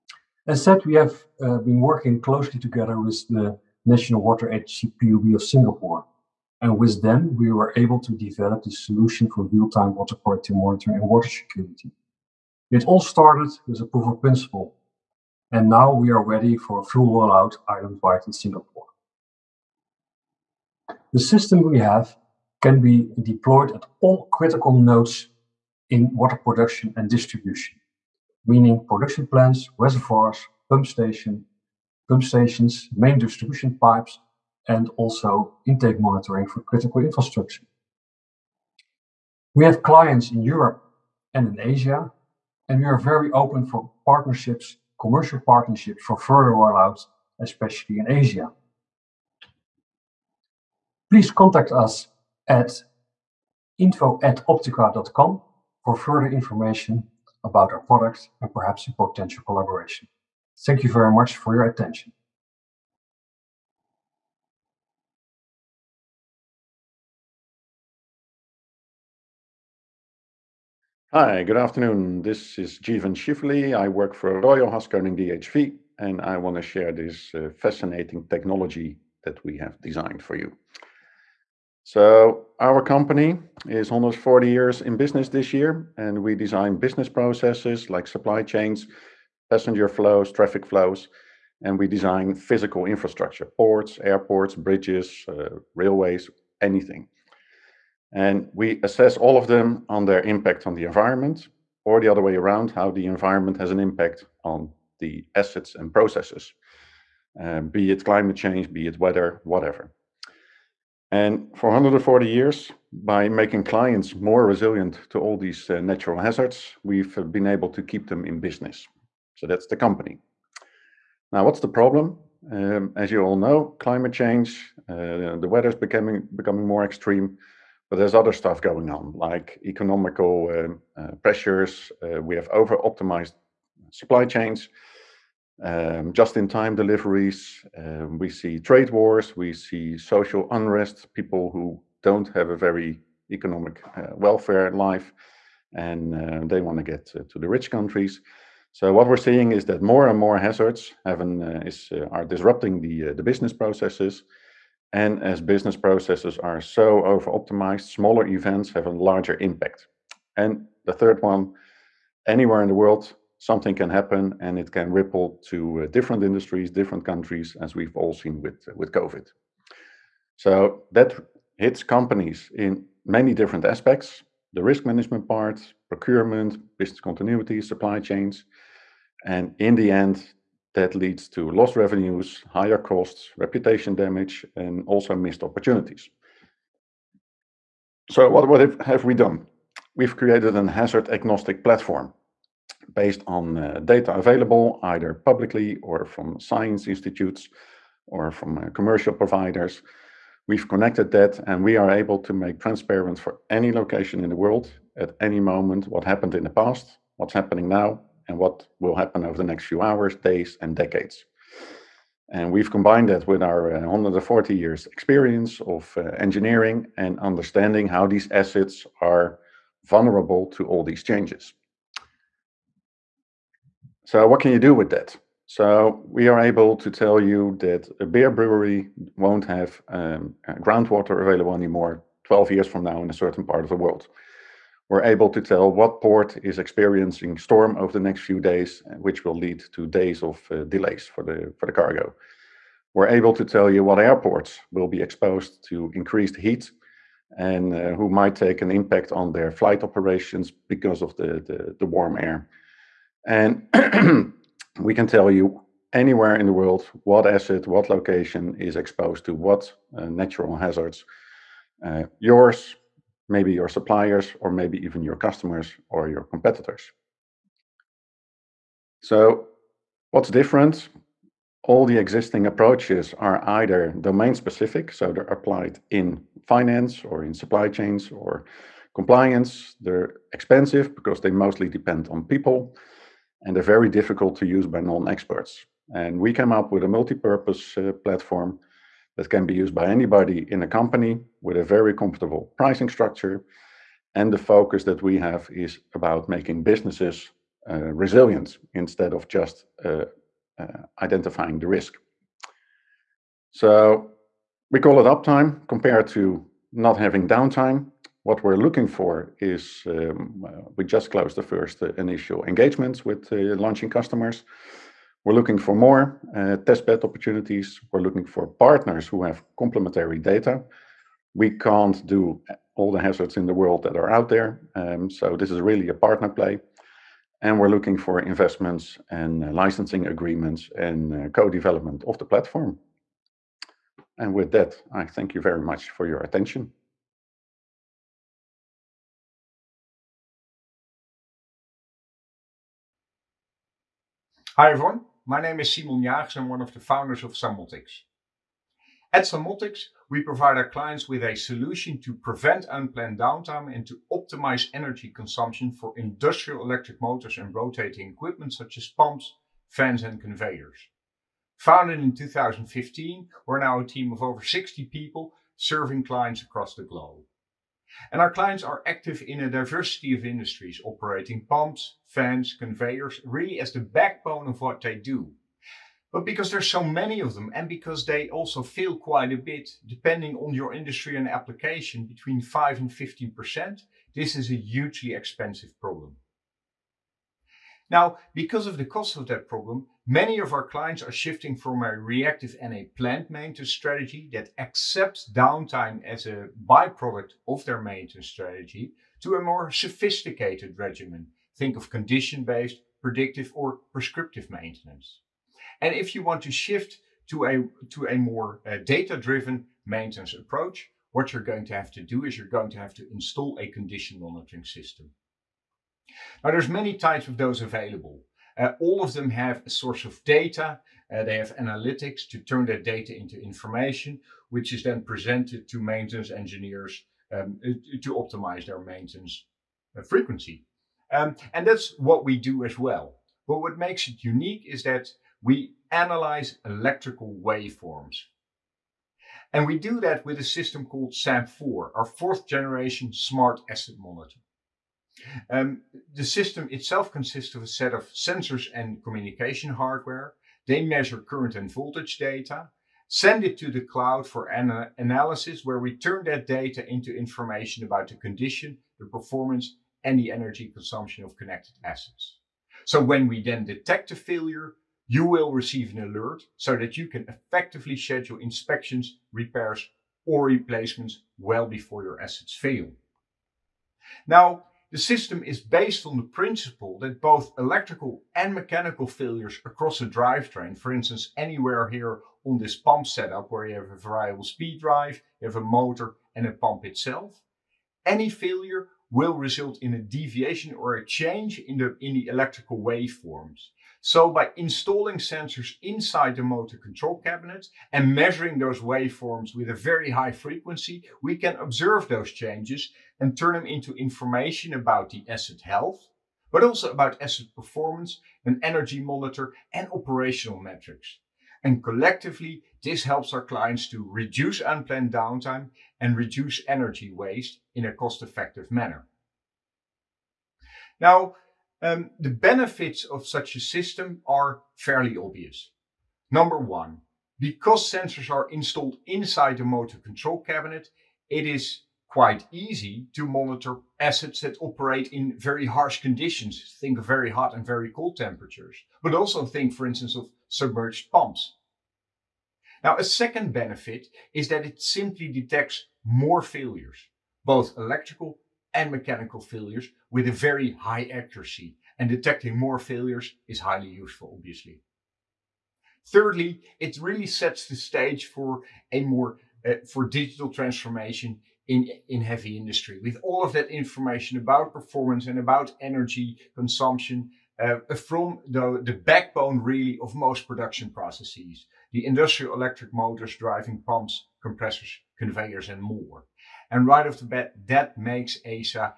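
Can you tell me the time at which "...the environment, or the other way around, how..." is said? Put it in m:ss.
1:40.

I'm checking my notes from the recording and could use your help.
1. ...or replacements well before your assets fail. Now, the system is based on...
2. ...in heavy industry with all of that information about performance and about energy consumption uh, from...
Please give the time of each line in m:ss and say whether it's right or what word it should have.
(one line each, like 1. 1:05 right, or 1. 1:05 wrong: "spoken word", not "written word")
1. 7:50 right
2. 9:22 right.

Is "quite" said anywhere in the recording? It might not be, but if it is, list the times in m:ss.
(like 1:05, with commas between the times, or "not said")
6:18, 8:52.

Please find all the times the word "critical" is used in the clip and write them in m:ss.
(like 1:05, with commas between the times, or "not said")
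0:24, 0:36.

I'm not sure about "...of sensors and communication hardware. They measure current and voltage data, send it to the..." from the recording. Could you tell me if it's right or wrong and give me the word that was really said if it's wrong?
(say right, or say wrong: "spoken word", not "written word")
right.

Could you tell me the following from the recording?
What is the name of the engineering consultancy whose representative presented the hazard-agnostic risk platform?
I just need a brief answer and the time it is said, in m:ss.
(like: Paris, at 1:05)
Royal Haskoning DHV, at 1:14.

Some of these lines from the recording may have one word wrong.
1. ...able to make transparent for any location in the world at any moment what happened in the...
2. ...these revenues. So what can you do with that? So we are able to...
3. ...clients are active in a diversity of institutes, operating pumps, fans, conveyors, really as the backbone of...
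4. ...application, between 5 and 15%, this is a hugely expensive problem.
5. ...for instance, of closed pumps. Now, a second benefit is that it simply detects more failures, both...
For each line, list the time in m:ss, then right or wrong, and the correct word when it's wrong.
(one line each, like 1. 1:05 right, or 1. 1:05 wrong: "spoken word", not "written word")
1. 3:21 right
2. 3:40 wrong: "changes", not "revenues"
3. 6:08 wrong: "industries", not "institutes"
4. 6:21 right
5. 8:59 wrong: "submerged", not "closed".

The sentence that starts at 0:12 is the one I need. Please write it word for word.
It all started with a proof of principle, and now we are ready for a full rollout island-wide in Singapore.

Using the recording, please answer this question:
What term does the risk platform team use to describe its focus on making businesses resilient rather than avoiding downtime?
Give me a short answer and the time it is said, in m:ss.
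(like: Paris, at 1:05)
uptime, at 5:05.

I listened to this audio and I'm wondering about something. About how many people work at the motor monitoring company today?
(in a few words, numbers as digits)
over 60.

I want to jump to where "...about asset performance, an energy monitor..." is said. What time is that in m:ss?
8:26.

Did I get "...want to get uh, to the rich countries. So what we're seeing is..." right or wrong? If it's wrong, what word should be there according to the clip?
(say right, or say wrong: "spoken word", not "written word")
right.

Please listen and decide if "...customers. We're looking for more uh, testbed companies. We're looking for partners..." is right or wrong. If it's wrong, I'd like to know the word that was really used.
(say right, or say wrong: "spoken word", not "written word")
wrong: "opportunities", not "companies".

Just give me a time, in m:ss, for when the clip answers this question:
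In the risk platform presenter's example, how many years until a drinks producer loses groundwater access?
3:52.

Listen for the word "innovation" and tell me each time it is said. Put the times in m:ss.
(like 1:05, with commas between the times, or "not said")
not said.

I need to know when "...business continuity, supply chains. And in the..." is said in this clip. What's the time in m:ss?
2:56.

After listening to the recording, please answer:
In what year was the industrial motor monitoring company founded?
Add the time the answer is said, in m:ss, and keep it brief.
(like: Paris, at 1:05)
2015, at 6:02.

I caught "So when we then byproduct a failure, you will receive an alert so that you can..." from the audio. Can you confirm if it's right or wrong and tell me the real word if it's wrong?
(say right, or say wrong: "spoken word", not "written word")
wrong: "detect", not "byproduct".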